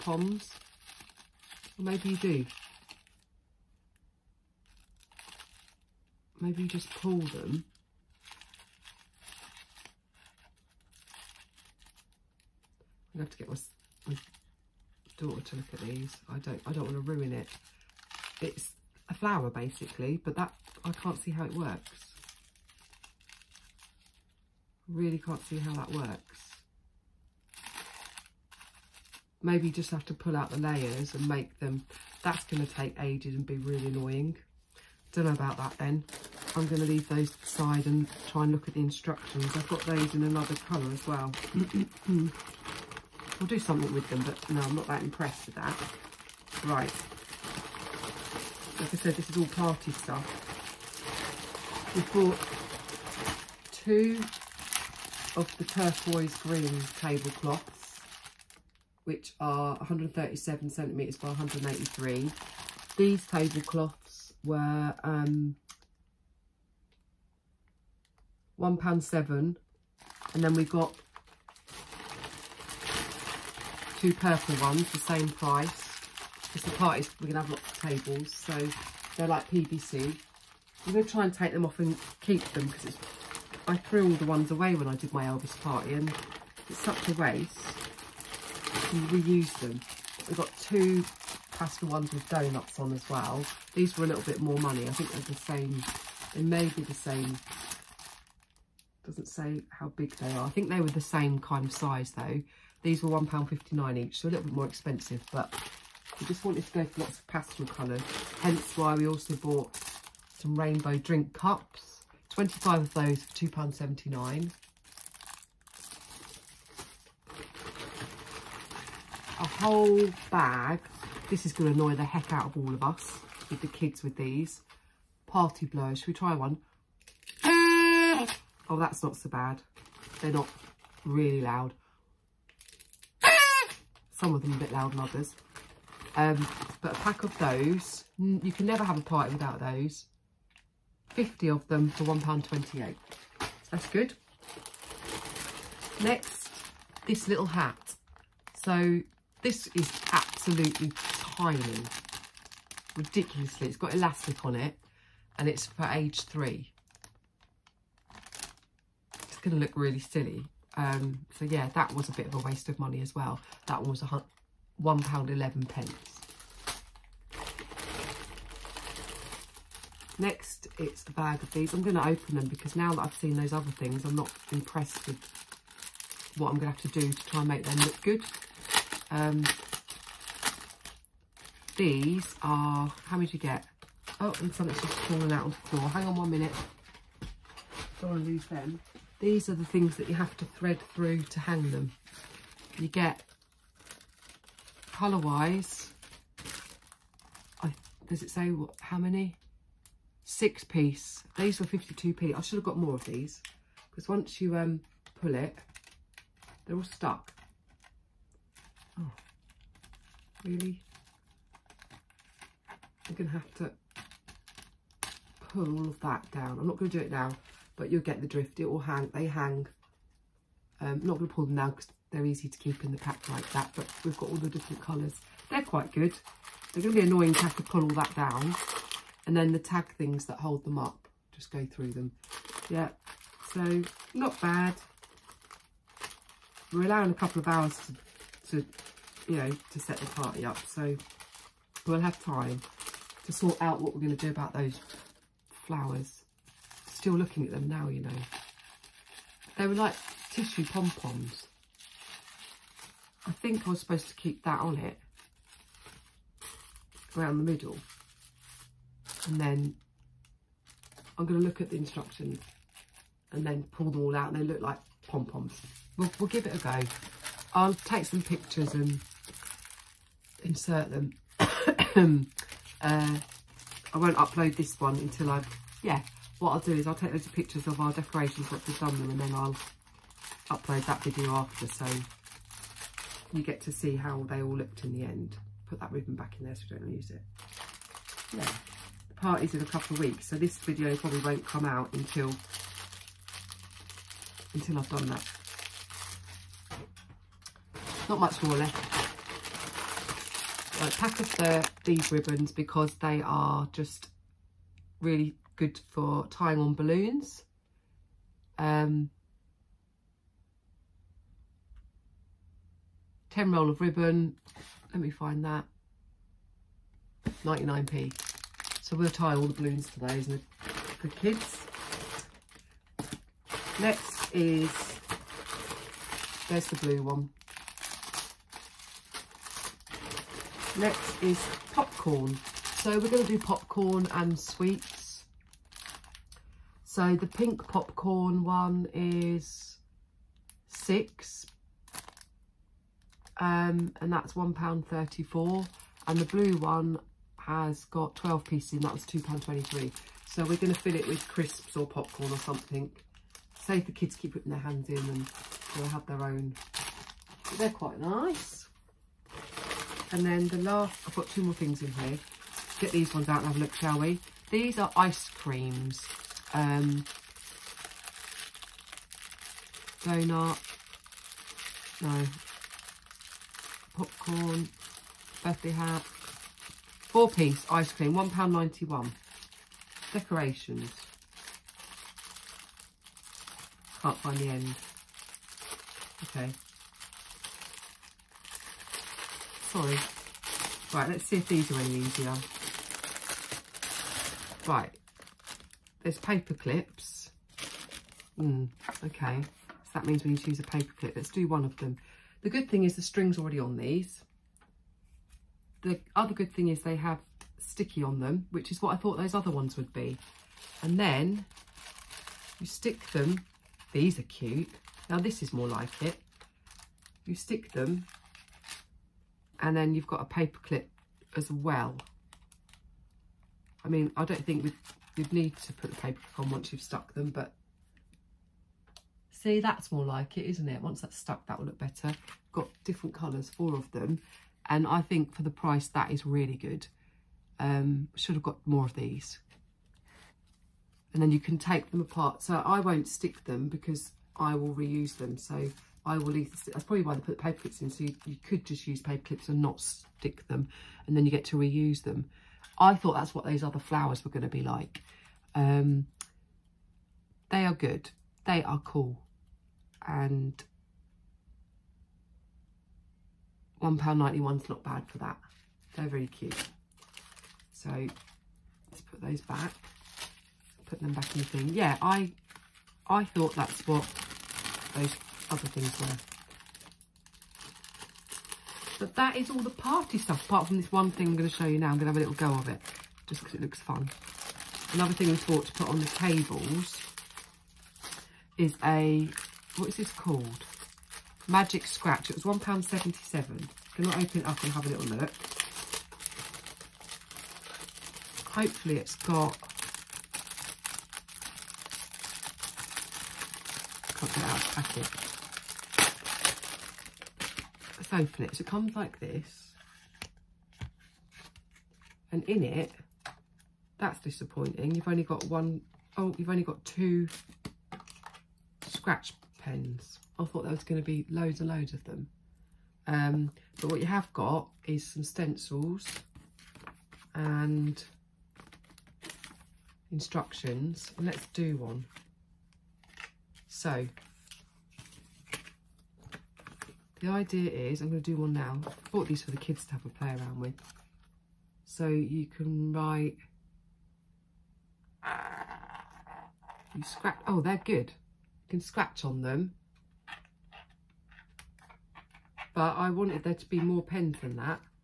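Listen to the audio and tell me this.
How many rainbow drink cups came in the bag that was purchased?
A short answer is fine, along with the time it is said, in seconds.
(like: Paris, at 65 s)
25, at 112 s.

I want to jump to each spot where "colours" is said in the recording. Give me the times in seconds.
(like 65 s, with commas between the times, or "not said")
40 s, 107 s, 194 s, 224 s, 433 s.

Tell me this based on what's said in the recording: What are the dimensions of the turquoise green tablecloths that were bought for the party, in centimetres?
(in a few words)
137 by 183.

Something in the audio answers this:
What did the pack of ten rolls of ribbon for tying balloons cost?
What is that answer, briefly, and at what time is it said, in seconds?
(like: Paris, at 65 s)
99p, at 317 s.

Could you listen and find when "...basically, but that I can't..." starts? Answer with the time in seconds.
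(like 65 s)
19 s.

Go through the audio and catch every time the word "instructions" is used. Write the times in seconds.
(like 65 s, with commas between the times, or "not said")
38 s, 261 s, 530 s.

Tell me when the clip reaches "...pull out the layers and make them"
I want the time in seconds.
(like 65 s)
30 s.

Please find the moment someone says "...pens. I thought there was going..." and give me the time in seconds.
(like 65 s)
519 s.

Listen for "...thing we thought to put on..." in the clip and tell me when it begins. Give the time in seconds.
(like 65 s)
485 s.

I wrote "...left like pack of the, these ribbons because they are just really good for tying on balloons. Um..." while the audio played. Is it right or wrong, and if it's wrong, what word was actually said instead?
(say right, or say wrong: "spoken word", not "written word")
right.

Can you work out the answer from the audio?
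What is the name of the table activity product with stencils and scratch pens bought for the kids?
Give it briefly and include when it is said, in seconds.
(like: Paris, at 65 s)
Magic Scratch, at 491 s.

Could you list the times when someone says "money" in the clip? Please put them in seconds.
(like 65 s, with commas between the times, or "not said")
94 s, 162 s.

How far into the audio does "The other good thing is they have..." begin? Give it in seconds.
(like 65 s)
405 s.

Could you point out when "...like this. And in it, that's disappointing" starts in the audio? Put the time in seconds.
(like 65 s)
508 s.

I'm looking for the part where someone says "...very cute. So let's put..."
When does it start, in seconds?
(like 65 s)
466 s.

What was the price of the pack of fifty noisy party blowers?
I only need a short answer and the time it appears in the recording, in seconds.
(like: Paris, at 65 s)
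£1.28, at 142 s.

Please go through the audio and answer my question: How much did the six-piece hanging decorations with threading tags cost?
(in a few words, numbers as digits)
52p.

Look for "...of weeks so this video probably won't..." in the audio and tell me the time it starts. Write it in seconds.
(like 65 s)
289 s.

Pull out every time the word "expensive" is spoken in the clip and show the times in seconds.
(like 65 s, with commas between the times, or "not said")
104 s.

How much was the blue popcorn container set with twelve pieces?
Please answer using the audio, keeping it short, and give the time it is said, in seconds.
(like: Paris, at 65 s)
£2.23, at 349 s.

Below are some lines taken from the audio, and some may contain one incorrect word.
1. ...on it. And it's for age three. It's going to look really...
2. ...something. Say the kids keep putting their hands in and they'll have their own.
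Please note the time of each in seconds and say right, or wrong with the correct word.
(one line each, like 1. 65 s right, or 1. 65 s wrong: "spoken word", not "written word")
1. 154 s right
2. 352 s right.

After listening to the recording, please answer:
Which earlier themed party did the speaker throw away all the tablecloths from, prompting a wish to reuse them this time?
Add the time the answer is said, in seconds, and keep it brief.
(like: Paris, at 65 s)
Elvis party, at 85 s.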